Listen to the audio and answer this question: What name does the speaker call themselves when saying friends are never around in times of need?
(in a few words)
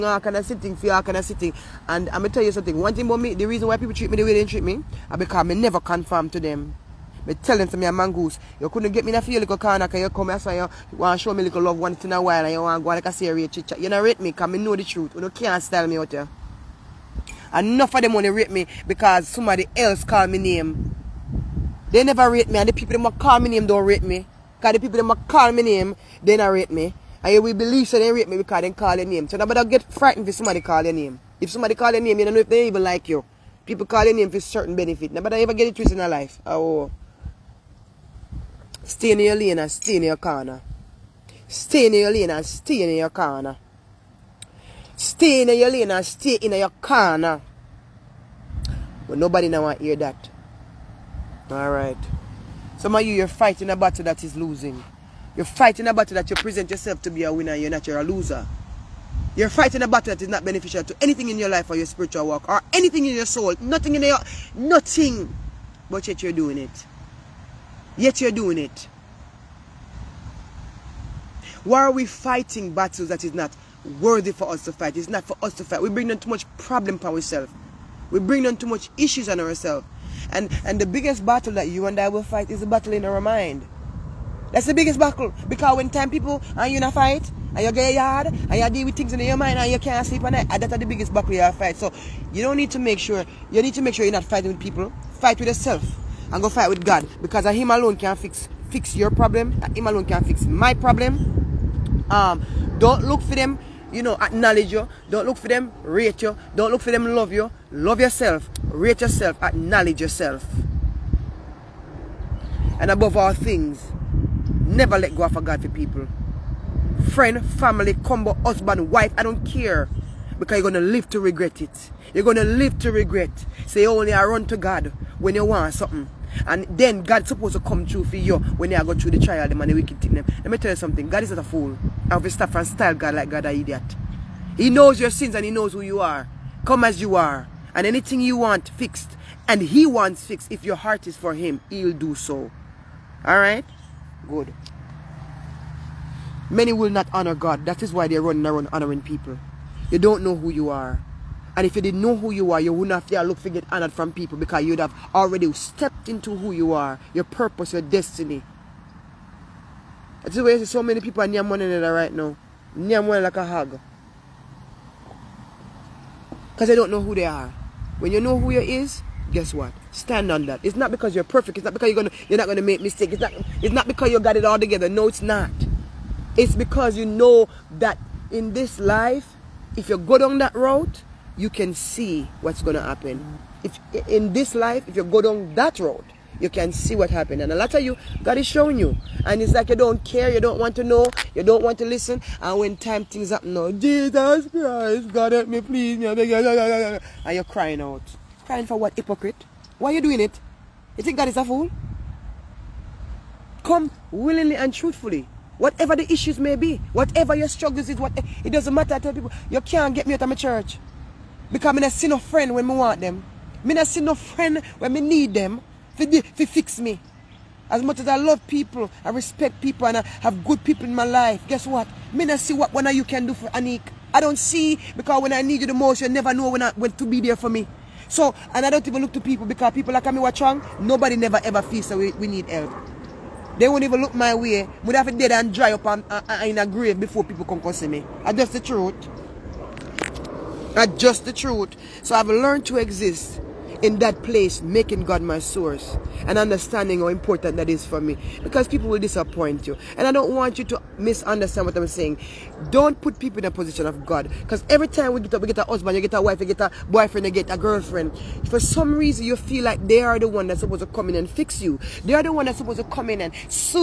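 Anik.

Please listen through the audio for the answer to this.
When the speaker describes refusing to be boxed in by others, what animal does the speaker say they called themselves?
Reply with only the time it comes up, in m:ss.
0:07.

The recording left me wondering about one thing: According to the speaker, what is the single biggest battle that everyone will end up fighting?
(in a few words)
the battle in our mind.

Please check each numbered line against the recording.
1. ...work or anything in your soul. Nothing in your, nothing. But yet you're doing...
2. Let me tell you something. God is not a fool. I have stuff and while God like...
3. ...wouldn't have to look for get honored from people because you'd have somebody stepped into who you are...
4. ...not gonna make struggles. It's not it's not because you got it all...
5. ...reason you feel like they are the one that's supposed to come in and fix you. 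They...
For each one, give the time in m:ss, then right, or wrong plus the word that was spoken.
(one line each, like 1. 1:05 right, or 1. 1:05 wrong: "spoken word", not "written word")
1. 1:02 right
2. 2:10 wrong: "style", not "while"
3. 2:32 wrong: "already", not "somebody"
4. 2:52 wrong: "mistakes", not "struggles"
5. 4:18 right.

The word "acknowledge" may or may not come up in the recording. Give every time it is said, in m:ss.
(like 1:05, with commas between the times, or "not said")
1:44, 1:49.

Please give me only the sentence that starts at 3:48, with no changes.
So, and I don't even look to people because people like watch Wachang, nobody never ever feels that we, we need help.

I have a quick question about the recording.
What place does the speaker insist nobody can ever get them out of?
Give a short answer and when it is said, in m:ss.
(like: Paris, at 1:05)
my church, at 3:30.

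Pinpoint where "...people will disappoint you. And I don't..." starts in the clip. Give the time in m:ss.
4:08.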